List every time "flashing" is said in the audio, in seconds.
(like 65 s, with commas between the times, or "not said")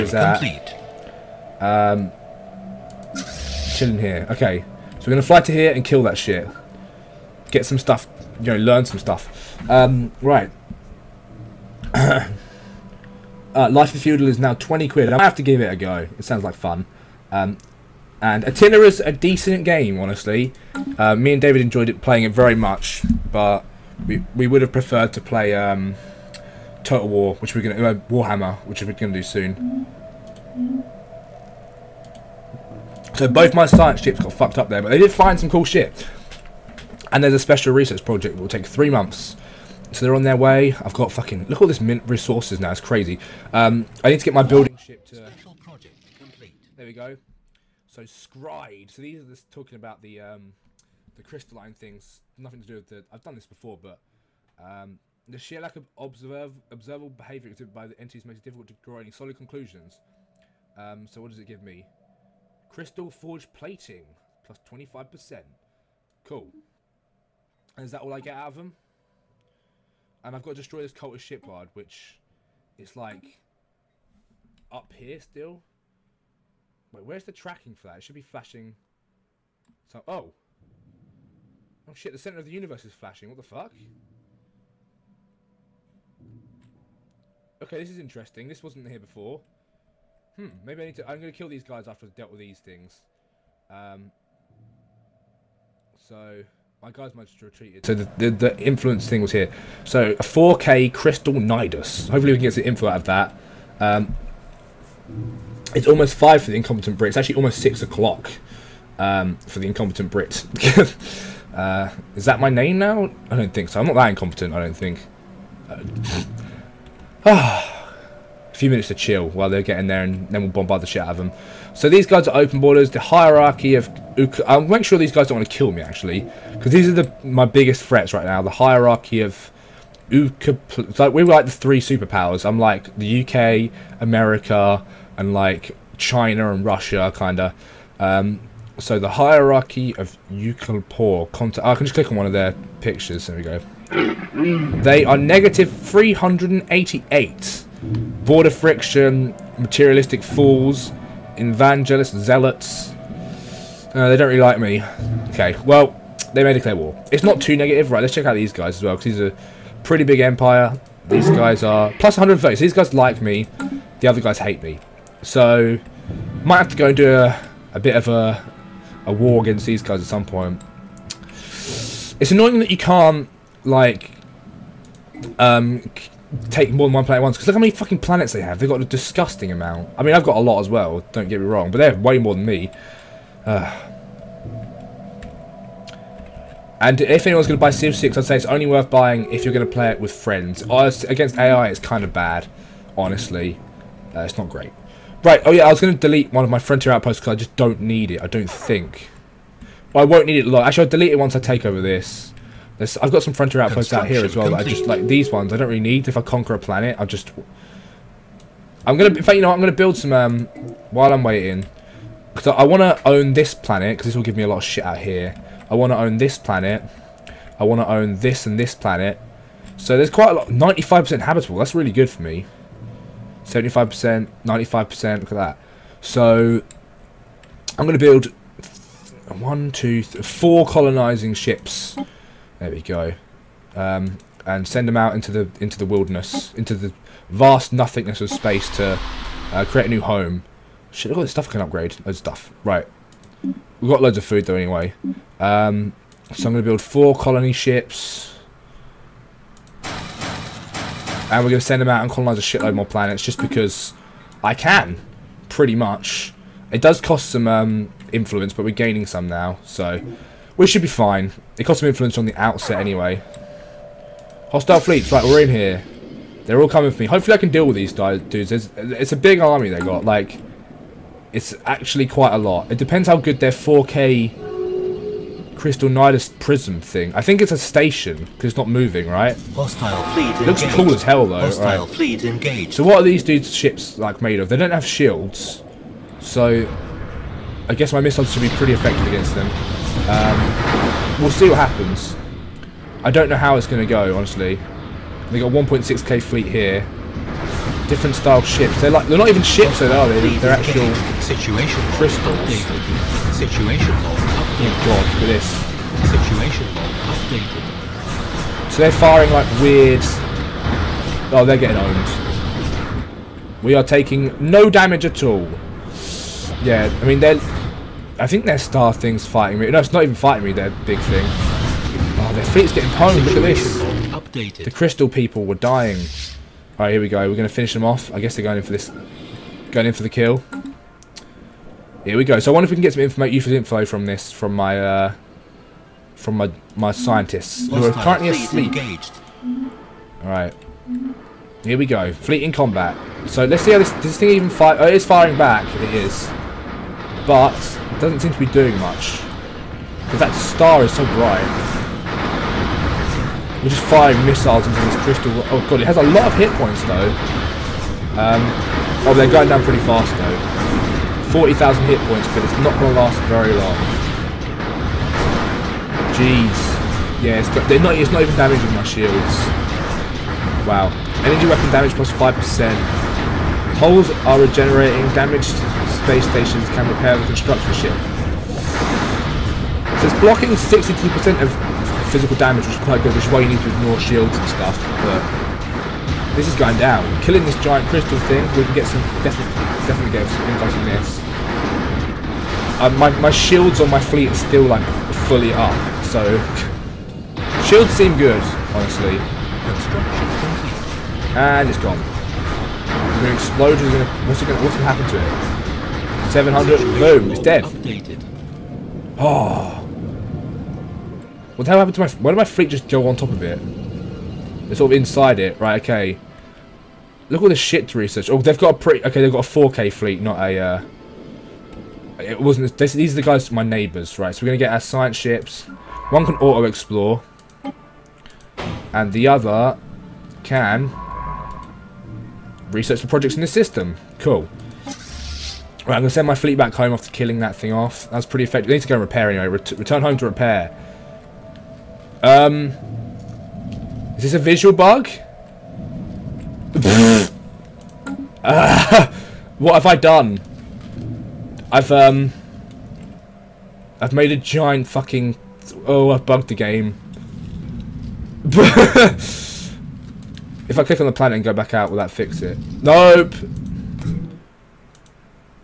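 78 s, 82 s.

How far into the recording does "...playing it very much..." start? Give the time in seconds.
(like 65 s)
22 s.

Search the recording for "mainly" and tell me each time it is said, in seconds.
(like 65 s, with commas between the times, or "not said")
not said.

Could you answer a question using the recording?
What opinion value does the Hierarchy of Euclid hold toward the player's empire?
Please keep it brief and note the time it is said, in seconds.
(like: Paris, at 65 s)
-388, at 145 s.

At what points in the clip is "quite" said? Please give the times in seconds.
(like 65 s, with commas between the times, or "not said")
220 s, 272 s, 382 s.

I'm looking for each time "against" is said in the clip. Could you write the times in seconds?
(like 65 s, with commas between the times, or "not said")
169 s, 191 s, 289 s.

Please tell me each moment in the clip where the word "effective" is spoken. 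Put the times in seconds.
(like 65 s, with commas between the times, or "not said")
288 s, 438 s.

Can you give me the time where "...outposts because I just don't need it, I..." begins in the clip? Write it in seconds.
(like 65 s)
196 s.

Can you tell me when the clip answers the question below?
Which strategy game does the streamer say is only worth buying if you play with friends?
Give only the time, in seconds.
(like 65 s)
187 s.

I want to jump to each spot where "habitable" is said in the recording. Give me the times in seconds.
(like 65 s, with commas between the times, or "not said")
221 s.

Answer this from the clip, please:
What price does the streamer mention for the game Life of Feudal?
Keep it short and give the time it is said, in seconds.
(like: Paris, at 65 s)
20 quid, at 14 s.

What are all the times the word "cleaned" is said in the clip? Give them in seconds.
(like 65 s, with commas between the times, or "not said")
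not said.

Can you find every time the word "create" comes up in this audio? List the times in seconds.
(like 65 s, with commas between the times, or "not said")
239 s.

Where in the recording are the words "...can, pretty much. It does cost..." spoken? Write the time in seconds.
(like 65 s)
254 s.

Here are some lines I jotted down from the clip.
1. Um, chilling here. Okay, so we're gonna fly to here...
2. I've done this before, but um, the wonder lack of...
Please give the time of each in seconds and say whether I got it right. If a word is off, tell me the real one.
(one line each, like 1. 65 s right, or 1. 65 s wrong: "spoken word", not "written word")
1. 1 s right
2. 53 s wrong: "sheer", not "wonder".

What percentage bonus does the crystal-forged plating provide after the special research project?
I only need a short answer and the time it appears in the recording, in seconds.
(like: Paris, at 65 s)
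25%, at 64 s.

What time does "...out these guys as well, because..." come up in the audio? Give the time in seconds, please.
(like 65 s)
158 s.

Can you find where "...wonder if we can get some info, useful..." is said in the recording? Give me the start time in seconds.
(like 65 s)
332 s.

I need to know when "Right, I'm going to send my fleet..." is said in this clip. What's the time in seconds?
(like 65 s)
435 s.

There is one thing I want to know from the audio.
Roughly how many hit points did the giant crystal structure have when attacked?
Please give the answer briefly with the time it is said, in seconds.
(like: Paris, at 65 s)
40,000, at 361 s.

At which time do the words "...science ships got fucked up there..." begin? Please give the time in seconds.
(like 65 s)
33 s.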